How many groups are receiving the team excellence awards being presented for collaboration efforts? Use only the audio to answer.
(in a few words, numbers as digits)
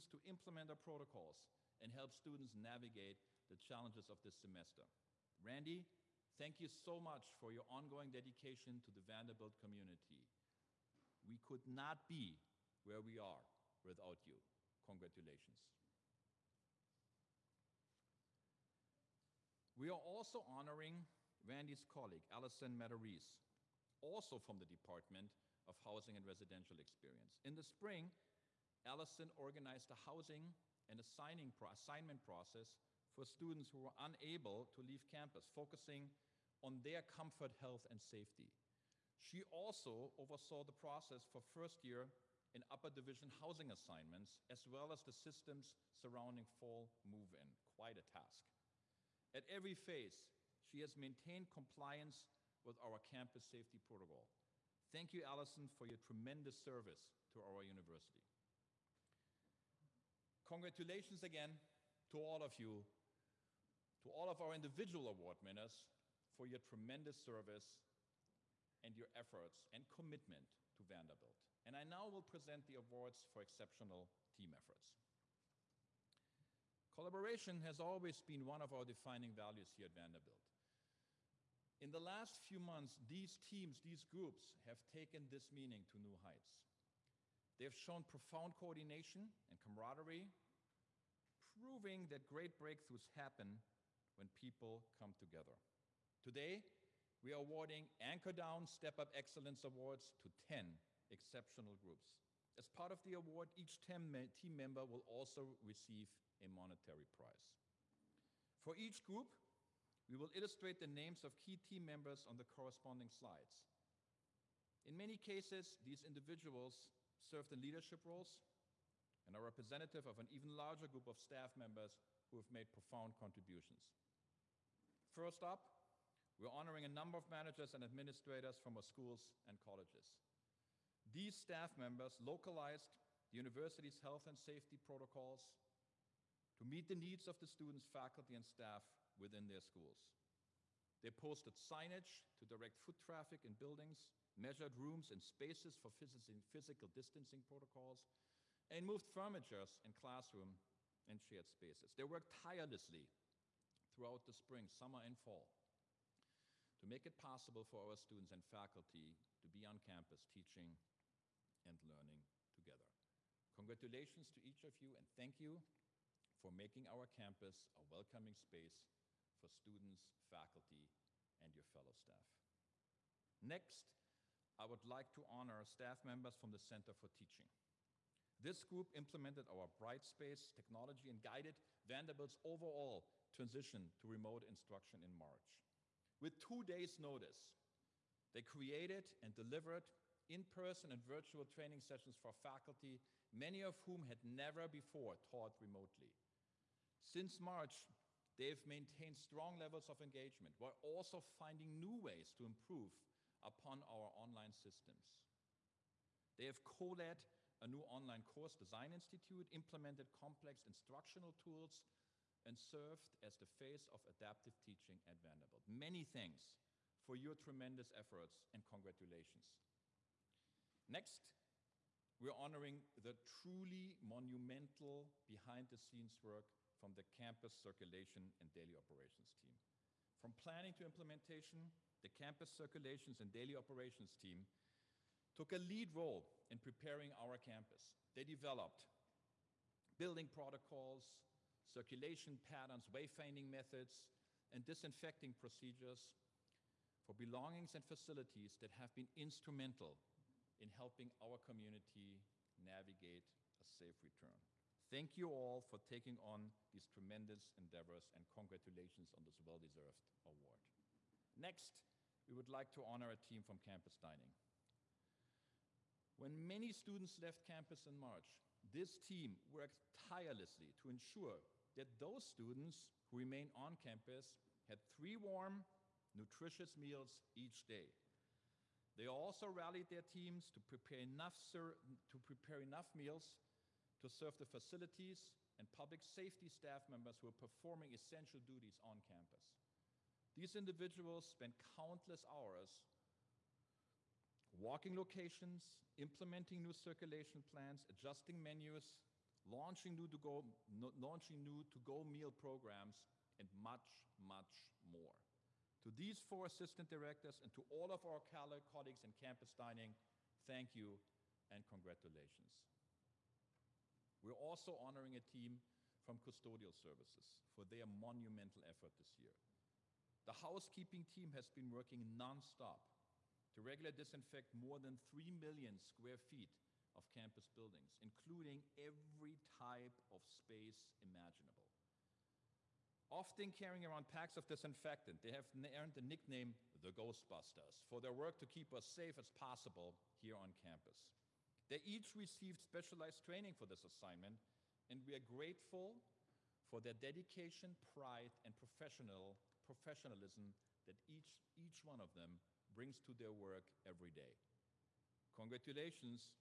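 10.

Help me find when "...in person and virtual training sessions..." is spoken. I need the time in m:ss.
3:10.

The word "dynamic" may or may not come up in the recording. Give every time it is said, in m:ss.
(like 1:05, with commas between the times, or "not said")
not said.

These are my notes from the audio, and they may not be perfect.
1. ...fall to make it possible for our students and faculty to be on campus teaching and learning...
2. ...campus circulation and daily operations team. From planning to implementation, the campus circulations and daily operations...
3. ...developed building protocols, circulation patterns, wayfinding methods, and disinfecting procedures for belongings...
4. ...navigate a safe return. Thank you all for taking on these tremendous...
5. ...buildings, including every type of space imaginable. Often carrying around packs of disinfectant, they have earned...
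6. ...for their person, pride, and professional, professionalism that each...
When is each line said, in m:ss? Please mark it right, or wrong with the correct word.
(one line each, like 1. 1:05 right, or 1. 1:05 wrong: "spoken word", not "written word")
1. 2:35 right
2. 3:47 right
3. 3:58 right
4. 4:12 right
5. 5:27 right
6. 5:46 wrong: "dedication", not "person".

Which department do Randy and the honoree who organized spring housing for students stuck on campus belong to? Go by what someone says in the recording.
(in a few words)
Housing and Residential Experience.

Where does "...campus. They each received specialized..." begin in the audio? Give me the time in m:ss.
5:40.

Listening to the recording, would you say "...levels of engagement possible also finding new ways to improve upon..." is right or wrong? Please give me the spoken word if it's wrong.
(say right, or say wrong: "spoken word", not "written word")
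wrong: "while", not "possible".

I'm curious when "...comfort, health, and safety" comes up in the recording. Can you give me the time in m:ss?
0:37.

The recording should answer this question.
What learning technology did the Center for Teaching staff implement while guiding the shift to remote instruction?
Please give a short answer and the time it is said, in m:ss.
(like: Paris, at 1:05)
Brightspace, at 2:59.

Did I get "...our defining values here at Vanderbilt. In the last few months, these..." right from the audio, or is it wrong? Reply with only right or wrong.
right.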